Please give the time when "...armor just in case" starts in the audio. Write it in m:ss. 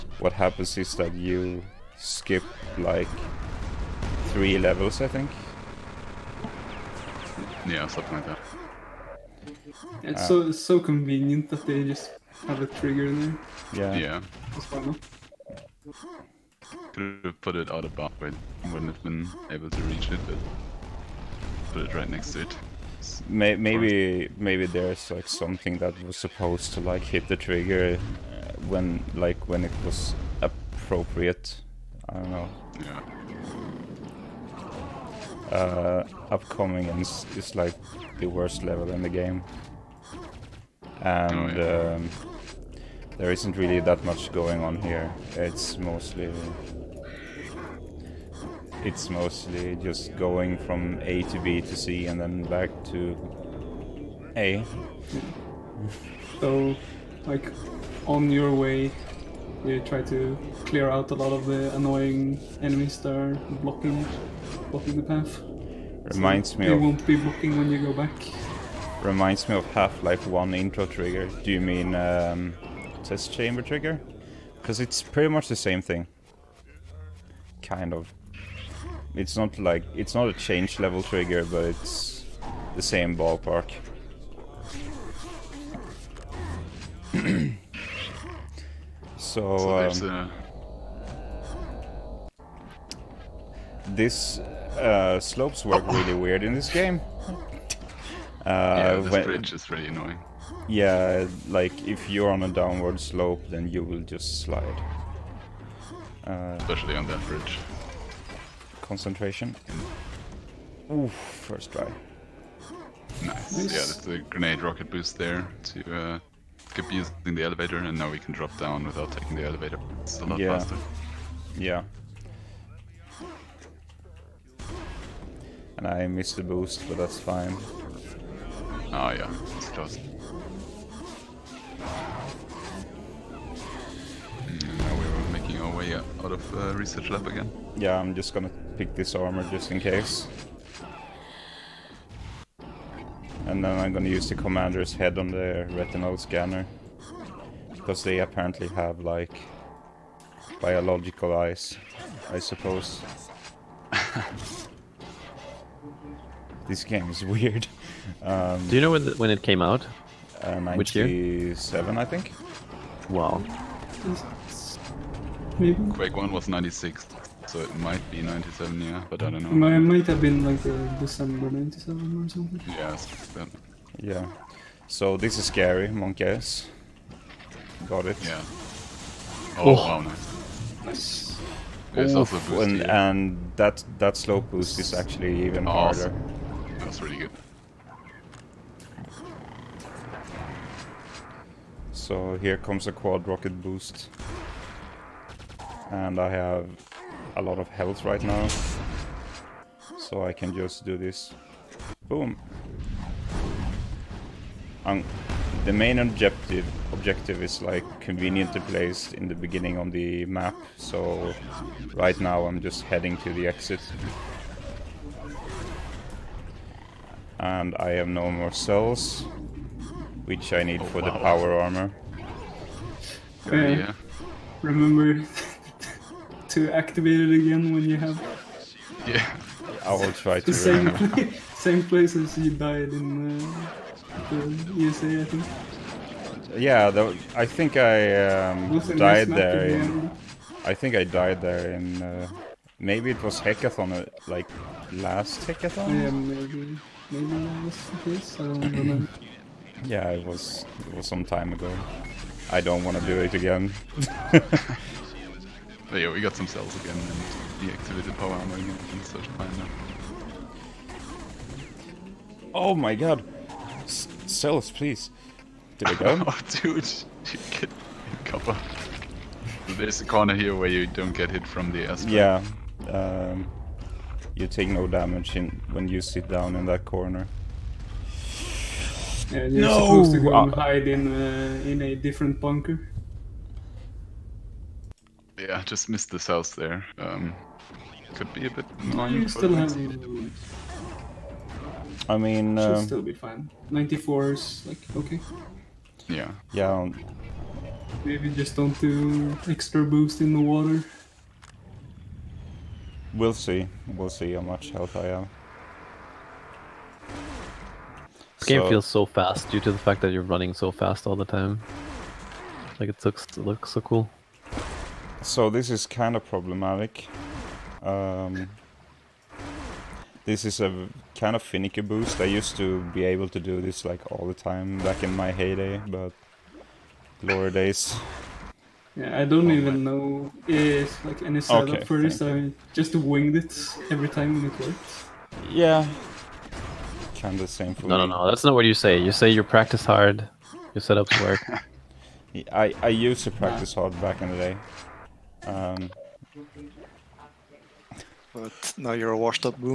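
2:19.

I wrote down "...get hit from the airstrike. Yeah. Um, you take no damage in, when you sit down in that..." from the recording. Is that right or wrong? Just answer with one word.
right.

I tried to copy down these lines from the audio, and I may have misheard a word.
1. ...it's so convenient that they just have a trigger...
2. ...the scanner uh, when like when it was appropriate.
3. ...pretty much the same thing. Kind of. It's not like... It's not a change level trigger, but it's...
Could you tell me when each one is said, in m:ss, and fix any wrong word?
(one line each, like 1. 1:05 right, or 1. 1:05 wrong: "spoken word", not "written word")
1. 0:10 right
2. 0:27 wrong: "trigger", not "scanner"
3. 1:15 right.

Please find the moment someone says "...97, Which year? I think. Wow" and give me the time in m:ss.
2:40.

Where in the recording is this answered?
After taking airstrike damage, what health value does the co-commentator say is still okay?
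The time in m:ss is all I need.
4:53.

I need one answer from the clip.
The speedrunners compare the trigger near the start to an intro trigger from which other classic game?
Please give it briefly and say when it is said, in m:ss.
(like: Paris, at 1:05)
Half-Life 1, at 1:09.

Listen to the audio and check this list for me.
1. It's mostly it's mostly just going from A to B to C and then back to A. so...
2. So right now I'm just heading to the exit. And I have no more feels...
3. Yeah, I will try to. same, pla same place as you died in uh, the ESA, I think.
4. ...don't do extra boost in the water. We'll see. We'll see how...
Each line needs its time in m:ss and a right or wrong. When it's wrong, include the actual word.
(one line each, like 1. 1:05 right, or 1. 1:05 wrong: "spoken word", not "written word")
1. 0:45 right
2. 3:30 wrong: "cells", not "feels"
3. 3:49 right
4. 4:58 right.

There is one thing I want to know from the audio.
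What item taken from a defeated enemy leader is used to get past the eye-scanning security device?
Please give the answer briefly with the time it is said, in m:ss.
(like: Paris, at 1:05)
commander's head, at 2:24.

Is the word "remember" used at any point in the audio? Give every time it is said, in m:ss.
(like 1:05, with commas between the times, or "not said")
3:44, 4:08.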